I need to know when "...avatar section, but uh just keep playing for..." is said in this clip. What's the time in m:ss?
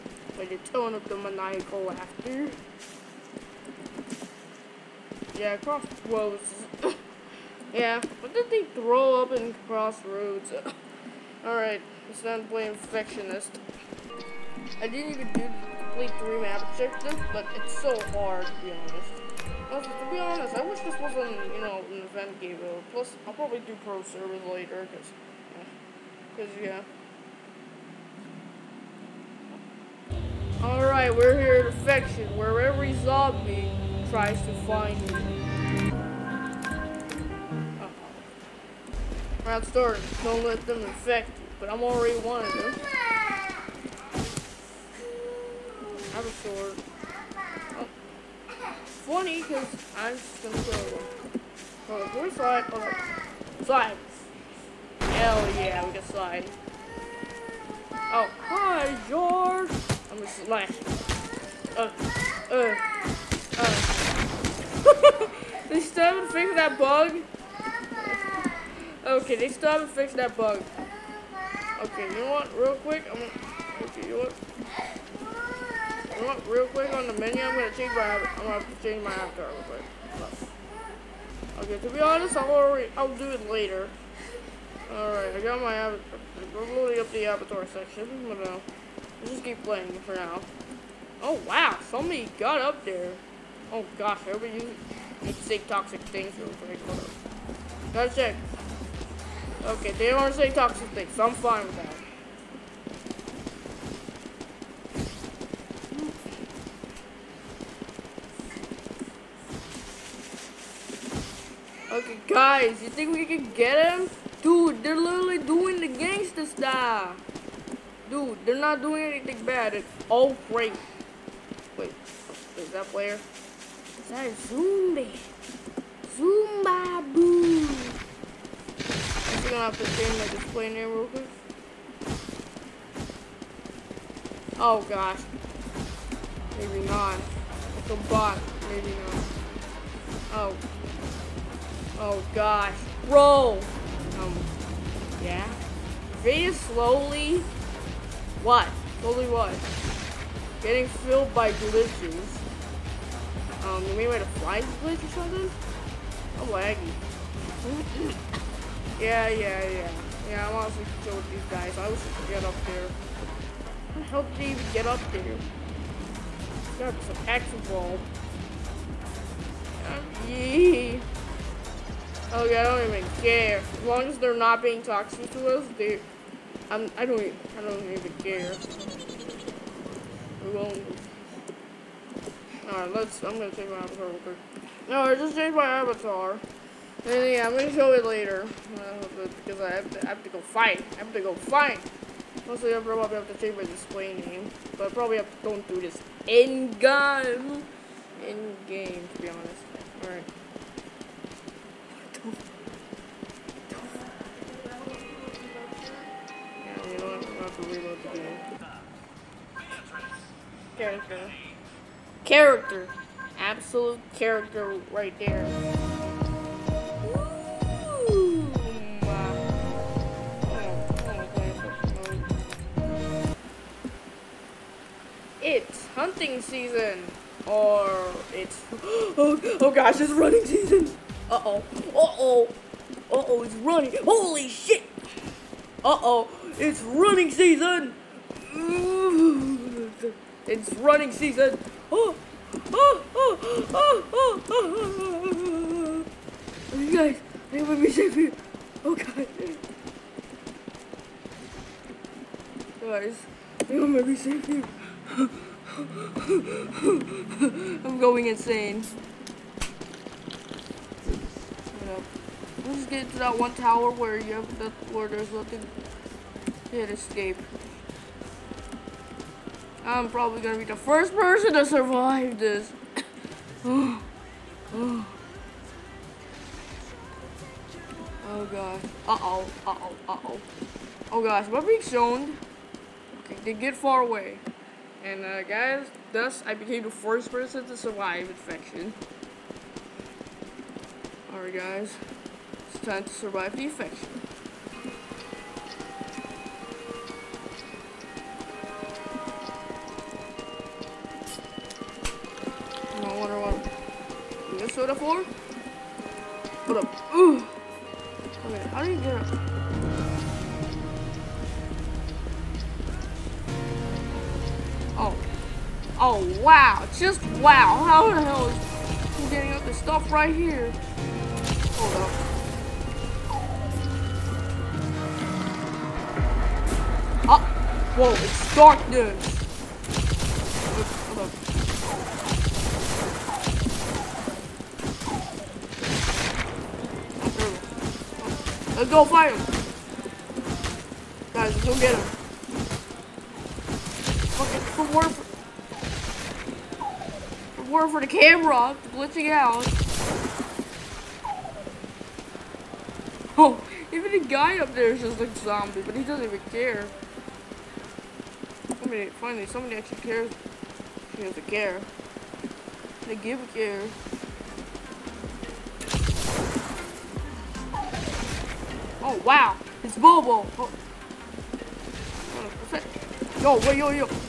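1:27.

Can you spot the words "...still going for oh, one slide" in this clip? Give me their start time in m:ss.
0:50.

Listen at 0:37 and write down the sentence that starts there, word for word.
Uh Round start, don't let them infect you, but I'm already one of them.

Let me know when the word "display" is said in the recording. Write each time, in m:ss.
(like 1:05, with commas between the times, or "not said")
2:10, 3:13.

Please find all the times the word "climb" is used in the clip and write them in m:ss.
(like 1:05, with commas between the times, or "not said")
not said.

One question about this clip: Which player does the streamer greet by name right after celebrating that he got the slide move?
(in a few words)
George.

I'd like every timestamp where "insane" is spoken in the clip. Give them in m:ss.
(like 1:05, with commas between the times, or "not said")
4:18.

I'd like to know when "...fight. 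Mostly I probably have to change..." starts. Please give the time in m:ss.
3:11.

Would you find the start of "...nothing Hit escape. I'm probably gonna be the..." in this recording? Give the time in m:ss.
4:25.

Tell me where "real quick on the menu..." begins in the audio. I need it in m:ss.
1:16.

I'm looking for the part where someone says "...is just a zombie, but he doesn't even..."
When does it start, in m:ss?
5:54.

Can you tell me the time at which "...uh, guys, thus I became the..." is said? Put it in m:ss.
4:45.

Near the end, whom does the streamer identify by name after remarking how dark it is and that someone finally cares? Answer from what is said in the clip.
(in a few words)
Bobo.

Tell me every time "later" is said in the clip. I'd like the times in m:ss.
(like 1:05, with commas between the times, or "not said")
0:24, 1:23, 3:08.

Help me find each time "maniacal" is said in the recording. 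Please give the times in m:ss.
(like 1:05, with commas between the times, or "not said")
0:01.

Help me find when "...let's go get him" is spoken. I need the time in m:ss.
5:41.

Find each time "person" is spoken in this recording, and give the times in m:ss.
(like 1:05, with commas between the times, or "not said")
4:31, 4:47.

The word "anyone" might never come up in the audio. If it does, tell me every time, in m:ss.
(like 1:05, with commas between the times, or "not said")
4:07.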